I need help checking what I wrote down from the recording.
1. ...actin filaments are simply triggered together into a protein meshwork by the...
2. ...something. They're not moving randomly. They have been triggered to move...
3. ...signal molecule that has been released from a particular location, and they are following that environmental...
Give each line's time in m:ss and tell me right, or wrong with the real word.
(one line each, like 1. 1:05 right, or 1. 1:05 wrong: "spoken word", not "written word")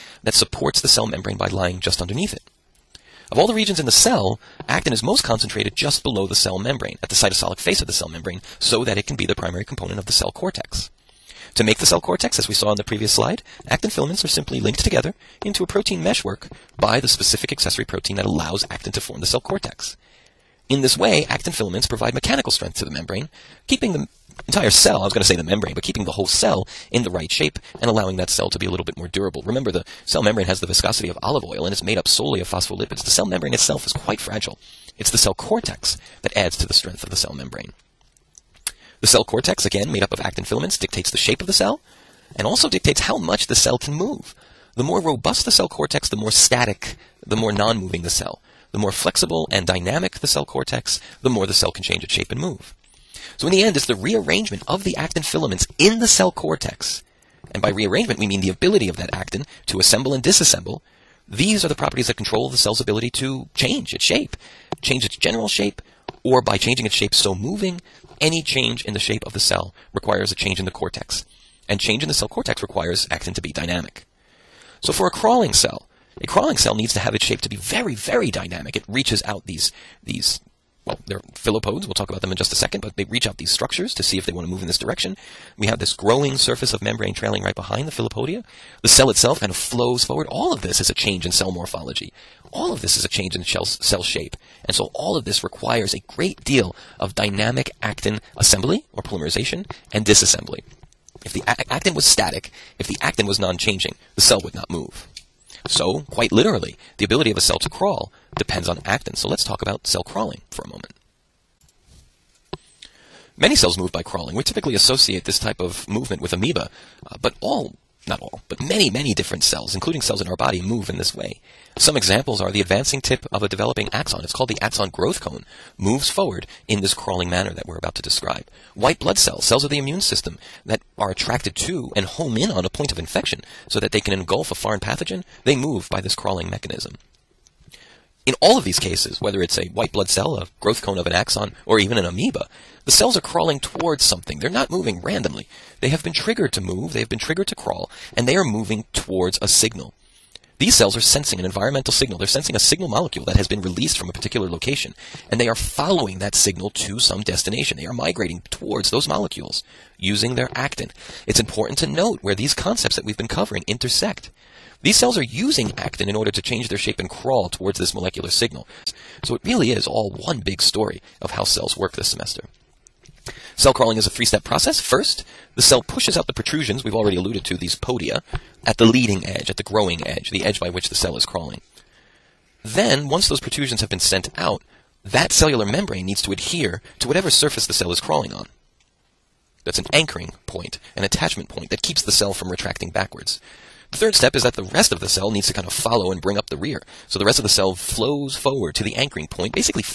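1. 0:13 wrong: "linked", not "triggered"
2. 2:24 right
3. 2:32 wrong: "signal", not "environmental".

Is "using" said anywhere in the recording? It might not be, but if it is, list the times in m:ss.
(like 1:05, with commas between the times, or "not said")
2:39, 2:45.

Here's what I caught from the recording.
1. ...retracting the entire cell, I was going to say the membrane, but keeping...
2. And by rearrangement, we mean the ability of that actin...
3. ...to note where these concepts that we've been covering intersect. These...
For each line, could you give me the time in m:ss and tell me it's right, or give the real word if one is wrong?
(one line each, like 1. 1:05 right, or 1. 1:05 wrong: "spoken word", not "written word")
1. 0:23 wrong: "keeping", not "retracting"
2. 0:57 right
3. 2:41 right.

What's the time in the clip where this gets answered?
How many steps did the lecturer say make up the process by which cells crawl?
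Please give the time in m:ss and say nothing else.
2:54.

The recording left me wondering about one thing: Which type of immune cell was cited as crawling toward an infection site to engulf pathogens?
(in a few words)
White blood cells.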